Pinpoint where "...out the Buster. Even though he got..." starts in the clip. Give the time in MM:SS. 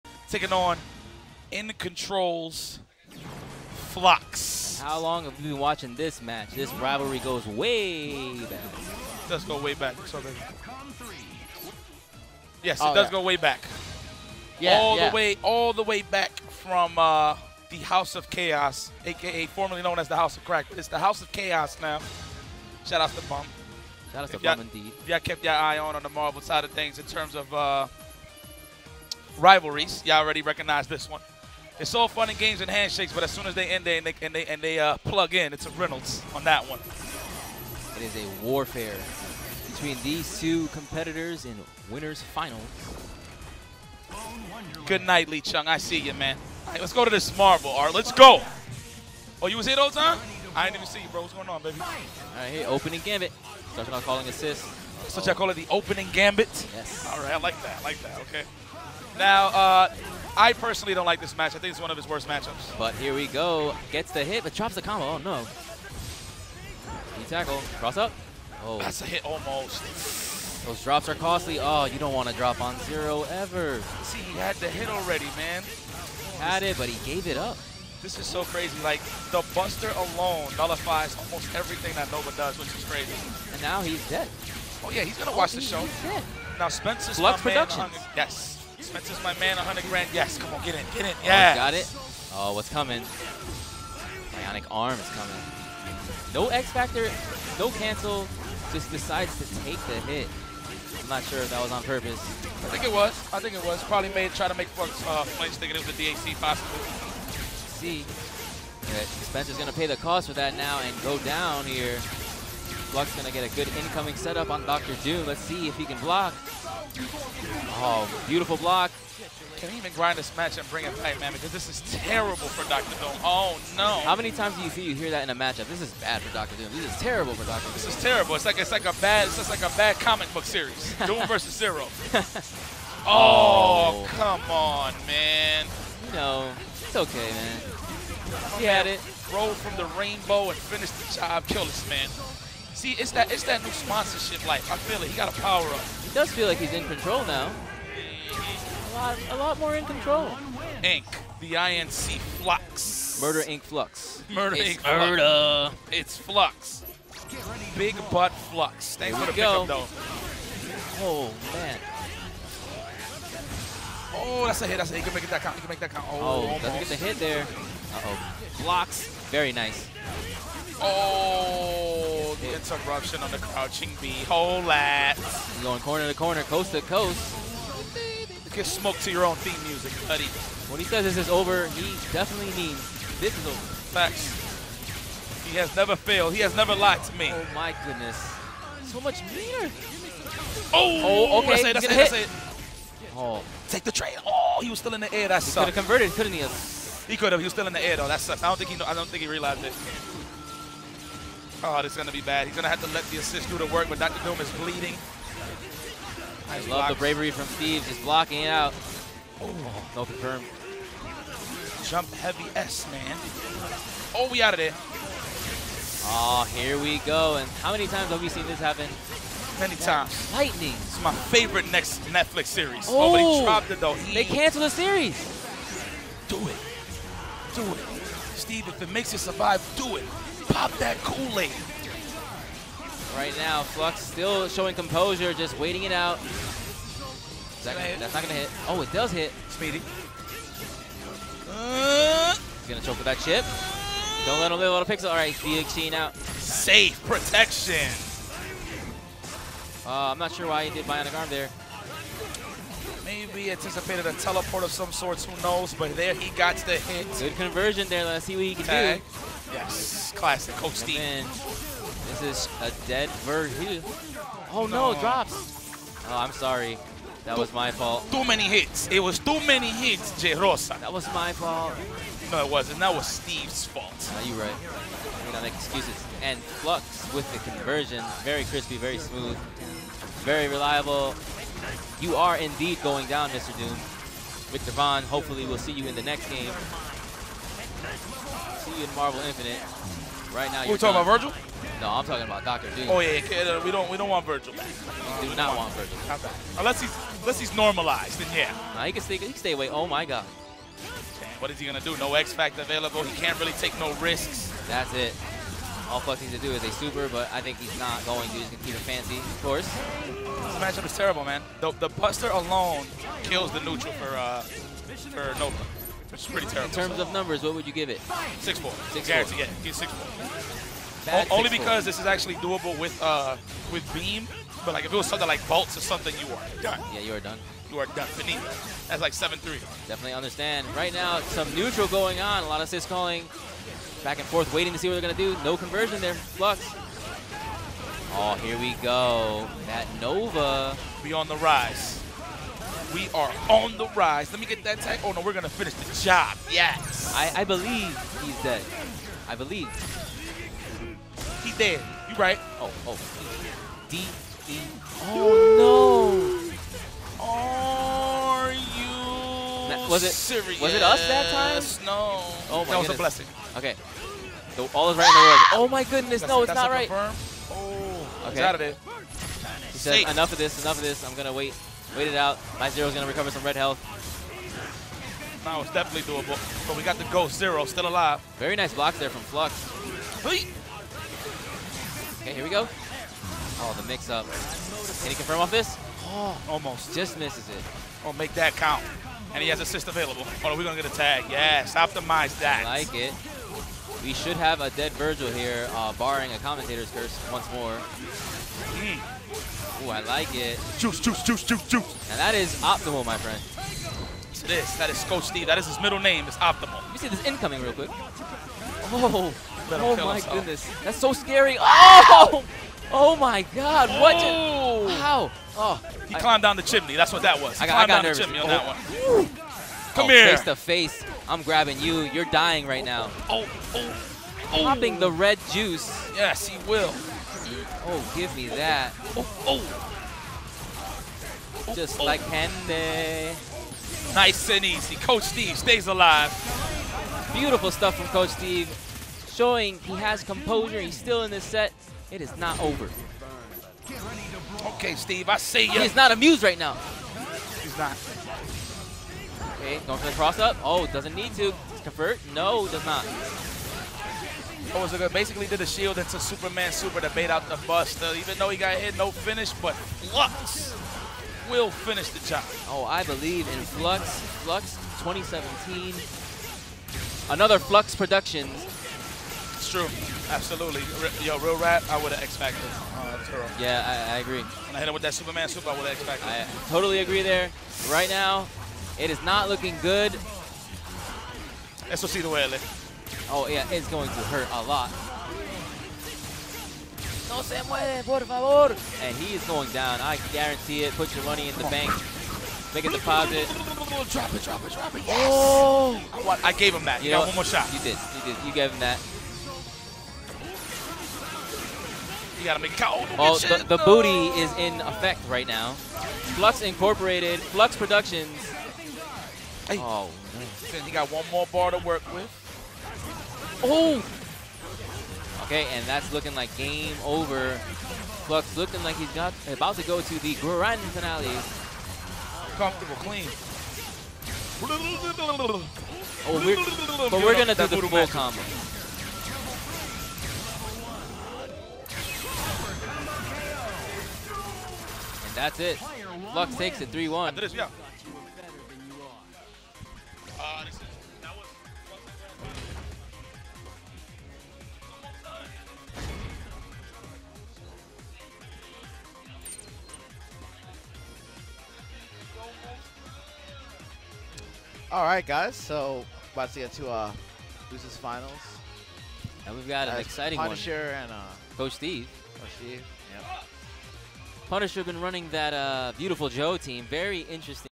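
07:37.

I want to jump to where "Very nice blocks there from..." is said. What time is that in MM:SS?
06:18.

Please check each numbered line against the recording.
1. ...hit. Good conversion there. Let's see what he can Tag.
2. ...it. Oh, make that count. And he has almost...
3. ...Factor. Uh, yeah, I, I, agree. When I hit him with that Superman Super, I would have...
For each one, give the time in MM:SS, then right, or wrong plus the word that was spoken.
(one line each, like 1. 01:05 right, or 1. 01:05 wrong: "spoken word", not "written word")
1. 04:16 right
2. 06:27 wrong: "assist", not "almost"
3. 07:52 right.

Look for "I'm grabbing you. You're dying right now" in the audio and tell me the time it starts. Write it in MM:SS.
07:01.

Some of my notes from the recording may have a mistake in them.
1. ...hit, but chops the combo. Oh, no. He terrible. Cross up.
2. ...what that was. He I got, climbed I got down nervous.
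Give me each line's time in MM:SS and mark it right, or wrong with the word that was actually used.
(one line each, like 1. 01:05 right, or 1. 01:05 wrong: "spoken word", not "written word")
1. 01:04 wrong: "tackle", not "terrible"
2. 06:57 right.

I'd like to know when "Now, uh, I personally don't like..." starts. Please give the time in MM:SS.
00:59.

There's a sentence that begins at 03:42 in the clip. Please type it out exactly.
Oh, oh but dropped it, though.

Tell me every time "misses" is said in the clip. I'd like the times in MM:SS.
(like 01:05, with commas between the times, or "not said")
06:27.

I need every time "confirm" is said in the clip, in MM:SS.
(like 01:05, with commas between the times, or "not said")
03:30, 06:06, 06:25.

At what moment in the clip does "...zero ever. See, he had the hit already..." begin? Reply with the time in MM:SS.
01:12.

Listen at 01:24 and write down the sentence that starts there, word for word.
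Oh, yeah, he's going to watch oh, the show.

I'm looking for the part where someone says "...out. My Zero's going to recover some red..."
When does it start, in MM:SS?
06:12.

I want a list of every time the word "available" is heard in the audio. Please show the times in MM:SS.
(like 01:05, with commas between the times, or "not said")
05:02, 06:29.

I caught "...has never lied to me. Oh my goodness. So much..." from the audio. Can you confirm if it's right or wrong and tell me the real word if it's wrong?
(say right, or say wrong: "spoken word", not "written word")
right.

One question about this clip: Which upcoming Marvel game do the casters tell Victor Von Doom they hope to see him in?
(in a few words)
Marvel Infinite.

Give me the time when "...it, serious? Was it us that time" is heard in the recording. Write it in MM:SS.
06:00.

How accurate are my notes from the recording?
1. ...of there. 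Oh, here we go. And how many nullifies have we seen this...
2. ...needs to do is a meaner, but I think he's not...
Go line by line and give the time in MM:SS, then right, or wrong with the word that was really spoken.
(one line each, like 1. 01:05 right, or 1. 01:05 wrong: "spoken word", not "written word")
1. 03:34 wrong: "times", not "nullifies"
2. 05:06 wrong: "super", not "meaner".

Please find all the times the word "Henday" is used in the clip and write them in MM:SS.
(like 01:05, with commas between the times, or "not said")
07:12.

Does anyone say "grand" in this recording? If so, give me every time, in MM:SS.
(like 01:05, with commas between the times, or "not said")
01:29, 08:40.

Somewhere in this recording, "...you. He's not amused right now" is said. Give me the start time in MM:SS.
07:25.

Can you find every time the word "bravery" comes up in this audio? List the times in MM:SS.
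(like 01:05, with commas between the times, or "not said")
03:26.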